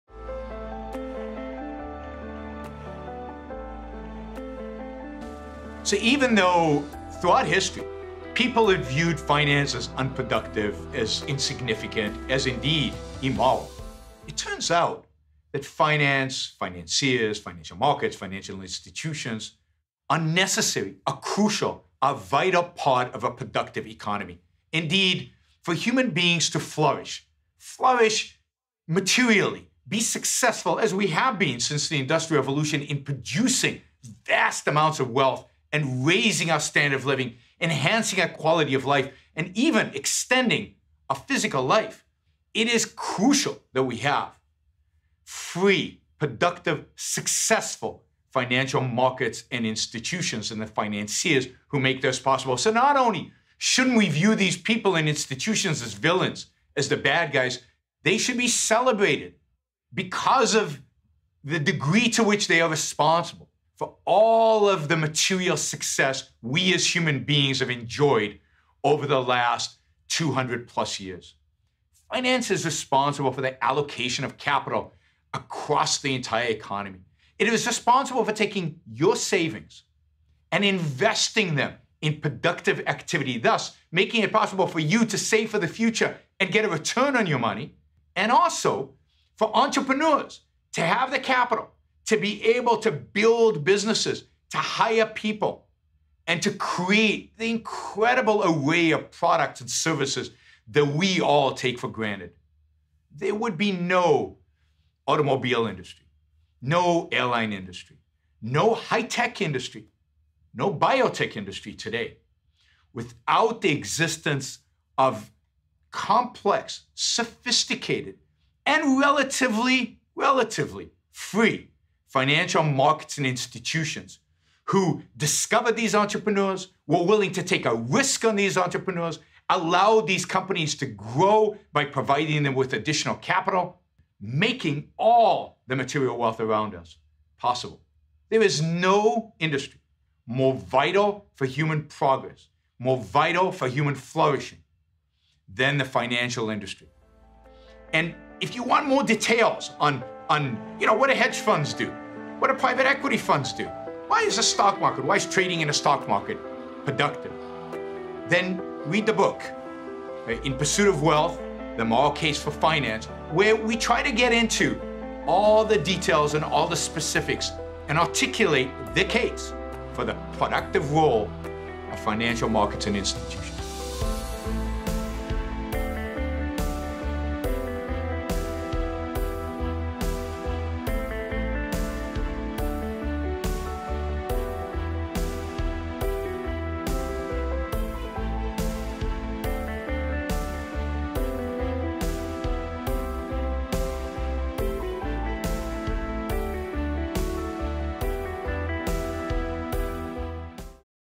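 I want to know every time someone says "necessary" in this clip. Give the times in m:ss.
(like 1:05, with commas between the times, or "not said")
0:20.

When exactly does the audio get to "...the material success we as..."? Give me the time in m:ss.
1:04.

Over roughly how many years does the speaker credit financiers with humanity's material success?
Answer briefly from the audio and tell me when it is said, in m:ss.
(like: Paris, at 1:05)
200 plus years, at 1:10.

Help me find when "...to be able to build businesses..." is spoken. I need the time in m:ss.
1:32.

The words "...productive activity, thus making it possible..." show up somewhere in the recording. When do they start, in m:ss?
1:22.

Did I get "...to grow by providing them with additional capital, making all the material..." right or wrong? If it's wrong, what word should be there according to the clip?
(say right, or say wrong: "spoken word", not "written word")
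right.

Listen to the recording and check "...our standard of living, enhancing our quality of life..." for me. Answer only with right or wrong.
right.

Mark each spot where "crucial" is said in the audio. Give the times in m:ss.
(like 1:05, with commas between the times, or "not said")
0:21, 0:42.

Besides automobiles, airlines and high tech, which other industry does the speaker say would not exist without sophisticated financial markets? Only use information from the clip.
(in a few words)
biotech industry.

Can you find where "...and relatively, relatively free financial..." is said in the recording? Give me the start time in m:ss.
1:58.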